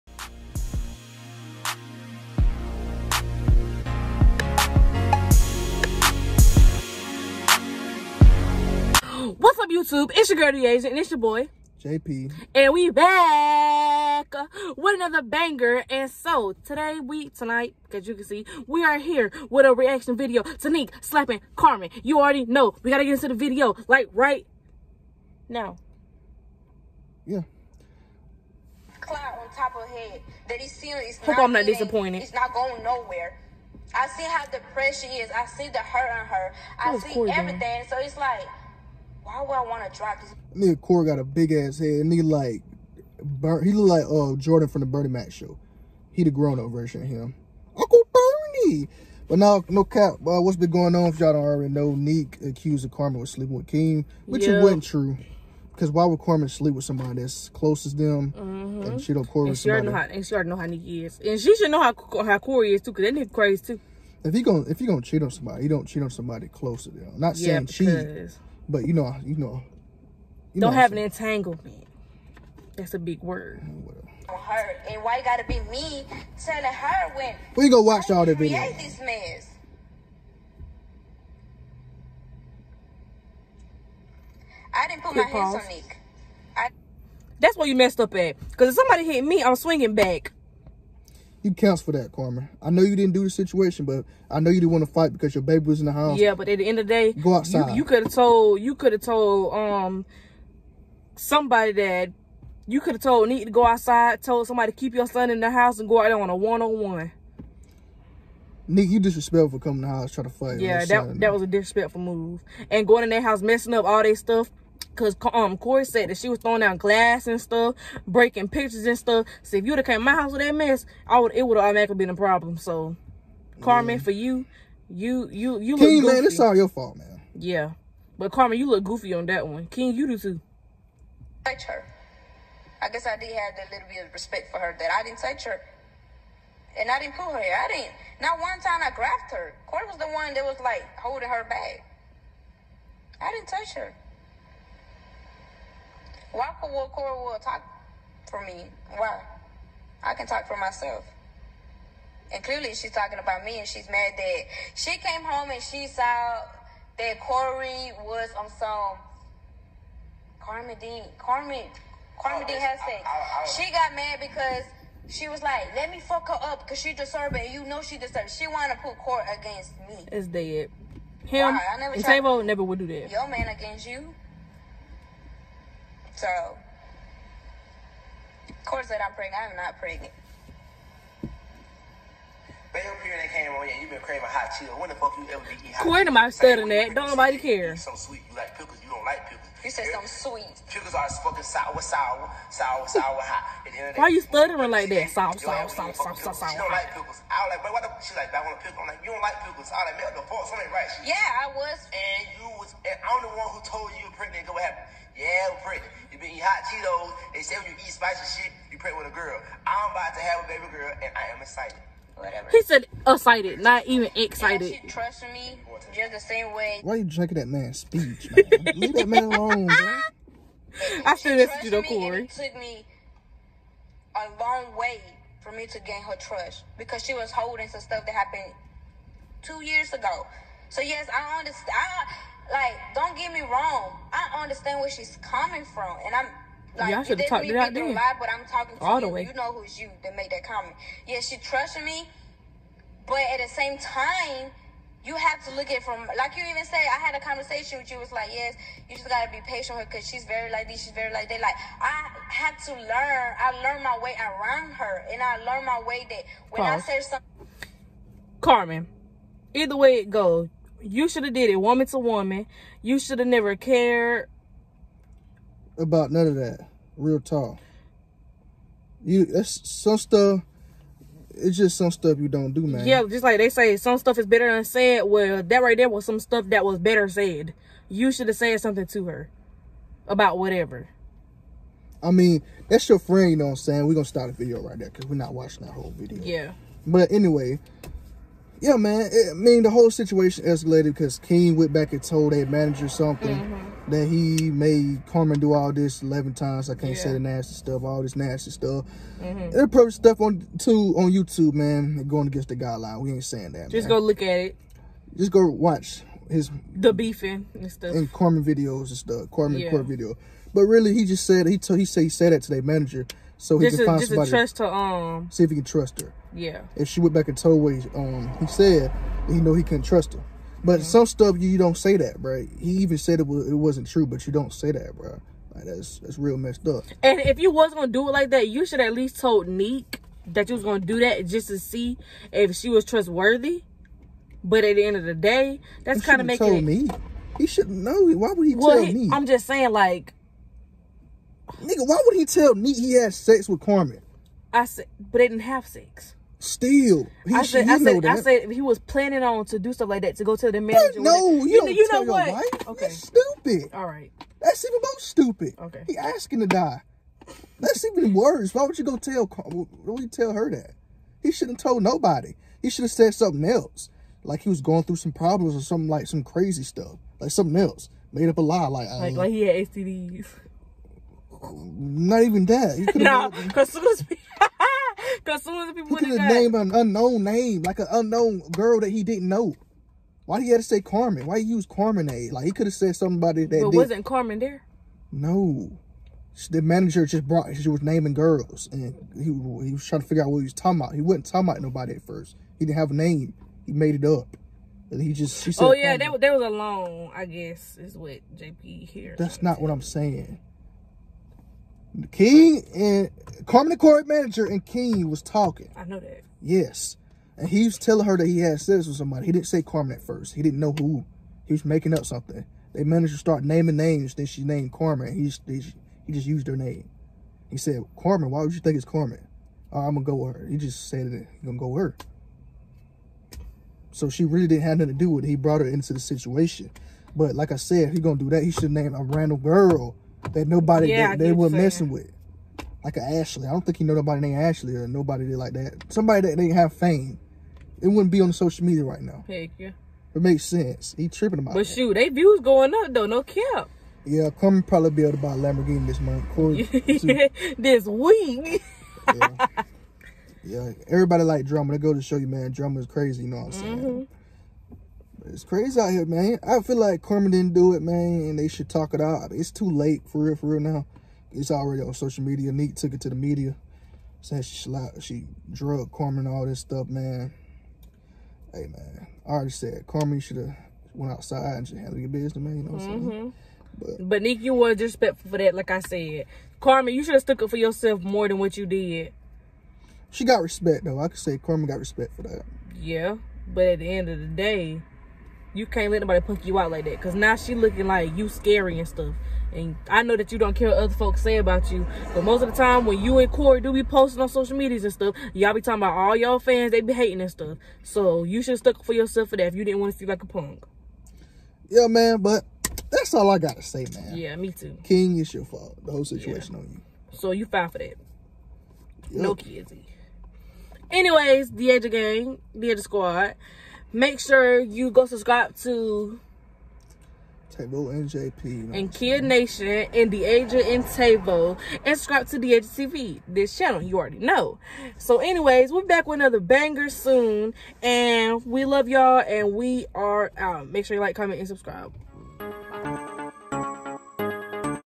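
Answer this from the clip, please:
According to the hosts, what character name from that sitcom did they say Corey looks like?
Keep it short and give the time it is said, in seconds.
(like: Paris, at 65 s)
Jordan, at 44 s.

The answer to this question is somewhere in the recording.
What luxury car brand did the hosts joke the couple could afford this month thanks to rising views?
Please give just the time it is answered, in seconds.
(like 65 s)
445 s.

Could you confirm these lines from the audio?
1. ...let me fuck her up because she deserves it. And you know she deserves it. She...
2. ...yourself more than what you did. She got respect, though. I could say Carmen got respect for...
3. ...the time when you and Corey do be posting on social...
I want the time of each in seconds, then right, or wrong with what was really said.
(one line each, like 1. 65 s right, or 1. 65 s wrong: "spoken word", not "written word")
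1. 165 s right
2. 477 s right
3. 492 s right.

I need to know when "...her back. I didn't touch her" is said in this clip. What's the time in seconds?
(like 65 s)
141 s.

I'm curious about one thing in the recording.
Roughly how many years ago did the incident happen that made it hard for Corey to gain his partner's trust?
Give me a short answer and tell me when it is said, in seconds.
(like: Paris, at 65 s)
2, at 229 s.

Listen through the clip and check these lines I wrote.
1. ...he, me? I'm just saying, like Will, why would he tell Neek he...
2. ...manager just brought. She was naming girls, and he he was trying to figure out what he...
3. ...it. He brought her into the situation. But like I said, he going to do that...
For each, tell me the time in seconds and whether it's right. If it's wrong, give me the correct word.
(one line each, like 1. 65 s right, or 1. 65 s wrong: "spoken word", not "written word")
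1. 338 s wrong: "Nigga", not "Will"
2. 386 s right
3. 425 s right.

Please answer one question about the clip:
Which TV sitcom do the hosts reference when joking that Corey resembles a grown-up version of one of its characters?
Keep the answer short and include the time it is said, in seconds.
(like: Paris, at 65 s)
The Bernie Mac Show, at 44 s.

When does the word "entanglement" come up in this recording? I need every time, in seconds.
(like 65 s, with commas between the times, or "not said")
70 s.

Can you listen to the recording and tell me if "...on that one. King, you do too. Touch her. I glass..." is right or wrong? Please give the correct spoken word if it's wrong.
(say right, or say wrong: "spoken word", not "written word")
wrong: "guess", not "glass".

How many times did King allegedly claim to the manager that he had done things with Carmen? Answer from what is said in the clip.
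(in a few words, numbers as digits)
11.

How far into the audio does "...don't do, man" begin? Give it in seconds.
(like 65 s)
272 s.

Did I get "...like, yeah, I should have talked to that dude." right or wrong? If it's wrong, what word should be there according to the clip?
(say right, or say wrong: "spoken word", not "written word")
right.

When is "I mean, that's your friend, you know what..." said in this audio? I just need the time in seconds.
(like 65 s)
282 s.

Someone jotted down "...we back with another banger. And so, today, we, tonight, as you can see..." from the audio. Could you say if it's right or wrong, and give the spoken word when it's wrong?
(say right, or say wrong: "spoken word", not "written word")
right.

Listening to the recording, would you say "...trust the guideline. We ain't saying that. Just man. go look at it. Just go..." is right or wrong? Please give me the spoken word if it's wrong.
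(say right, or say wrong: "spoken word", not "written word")
wrong: "against", not "trust".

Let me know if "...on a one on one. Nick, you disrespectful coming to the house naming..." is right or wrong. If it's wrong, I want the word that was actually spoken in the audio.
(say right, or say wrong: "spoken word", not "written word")
wrong: "trying", not "naming".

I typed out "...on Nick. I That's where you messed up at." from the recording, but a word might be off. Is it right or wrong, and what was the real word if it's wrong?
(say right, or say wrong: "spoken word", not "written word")
right.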